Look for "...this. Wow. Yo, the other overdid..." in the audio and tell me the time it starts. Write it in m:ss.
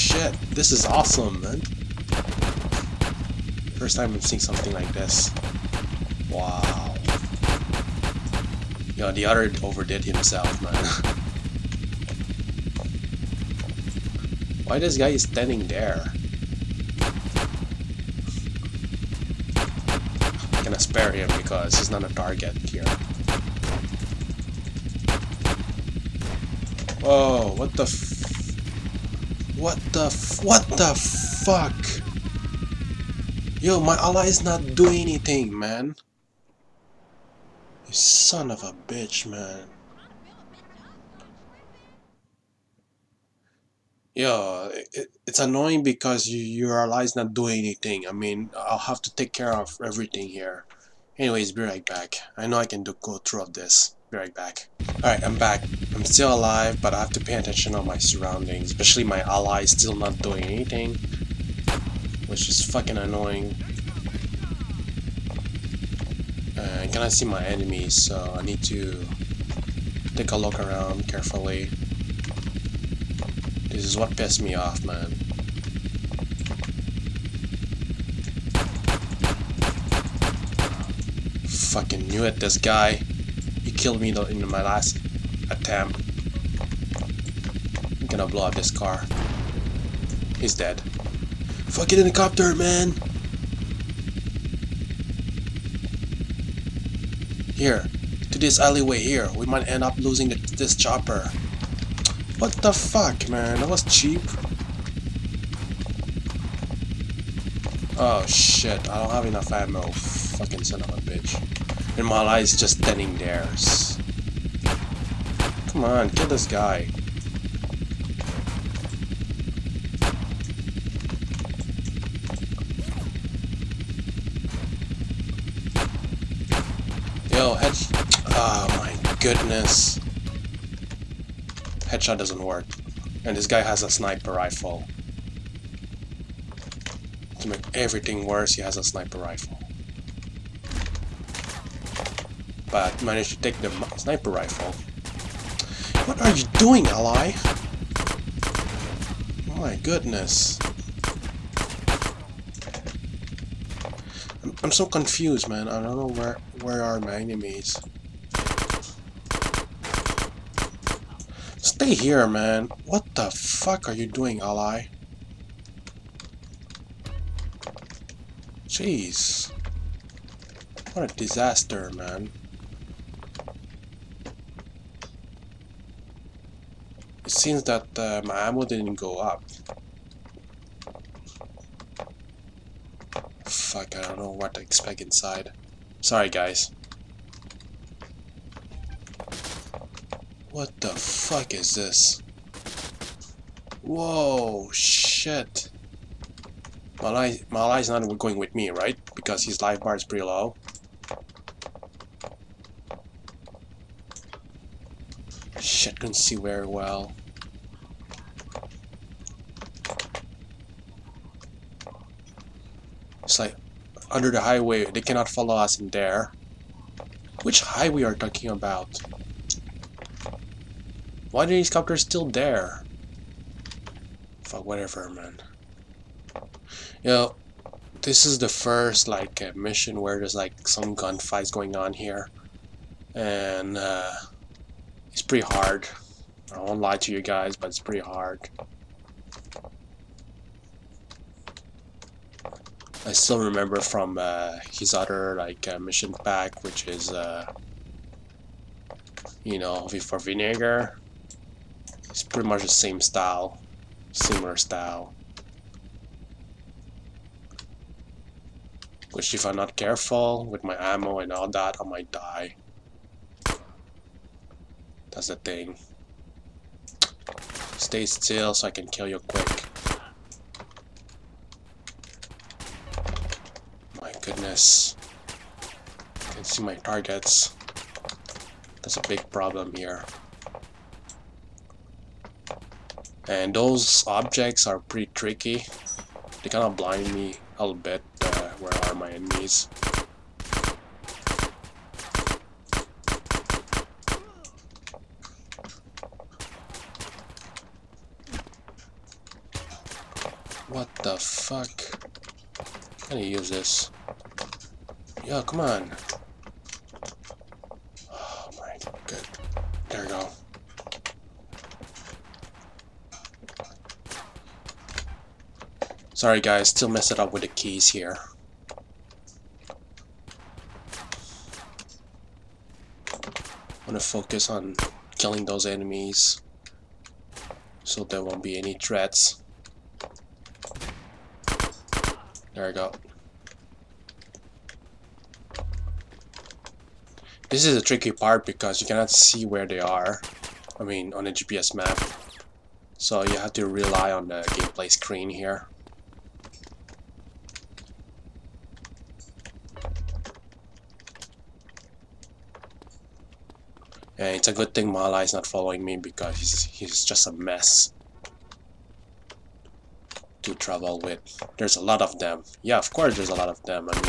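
0:04.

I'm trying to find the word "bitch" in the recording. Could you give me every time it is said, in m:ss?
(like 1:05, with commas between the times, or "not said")
0:38, 1:51.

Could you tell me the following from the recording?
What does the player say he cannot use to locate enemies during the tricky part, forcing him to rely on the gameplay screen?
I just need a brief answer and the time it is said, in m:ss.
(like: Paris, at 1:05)
GPS map, at 5:41.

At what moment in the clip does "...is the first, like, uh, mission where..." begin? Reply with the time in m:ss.
3:48.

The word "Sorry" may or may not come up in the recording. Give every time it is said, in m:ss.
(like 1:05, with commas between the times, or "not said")
3:05, 5:16.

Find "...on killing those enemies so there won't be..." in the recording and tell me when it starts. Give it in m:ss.
5:24.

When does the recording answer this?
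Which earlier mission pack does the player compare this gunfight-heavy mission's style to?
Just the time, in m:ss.
4:09.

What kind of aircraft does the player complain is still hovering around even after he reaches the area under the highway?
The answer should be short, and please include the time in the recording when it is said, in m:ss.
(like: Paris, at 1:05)
helicopters, at 3:41.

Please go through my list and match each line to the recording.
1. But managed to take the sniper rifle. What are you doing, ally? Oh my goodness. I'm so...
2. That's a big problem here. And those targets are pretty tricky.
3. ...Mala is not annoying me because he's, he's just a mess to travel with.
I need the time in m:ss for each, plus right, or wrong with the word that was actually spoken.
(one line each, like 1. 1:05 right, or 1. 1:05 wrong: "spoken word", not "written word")
1. 2:22 right
2. 4:38 wrong: "objects", not "targets"
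3. 5:54 wrong: "following", not "annoying".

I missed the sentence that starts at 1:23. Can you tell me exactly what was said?
He killed me in my last attempt.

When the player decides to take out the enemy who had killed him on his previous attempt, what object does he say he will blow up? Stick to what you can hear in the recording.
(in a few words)
car.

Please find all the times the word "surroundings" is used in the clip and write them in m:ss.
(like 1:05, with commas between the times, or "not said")
0:57.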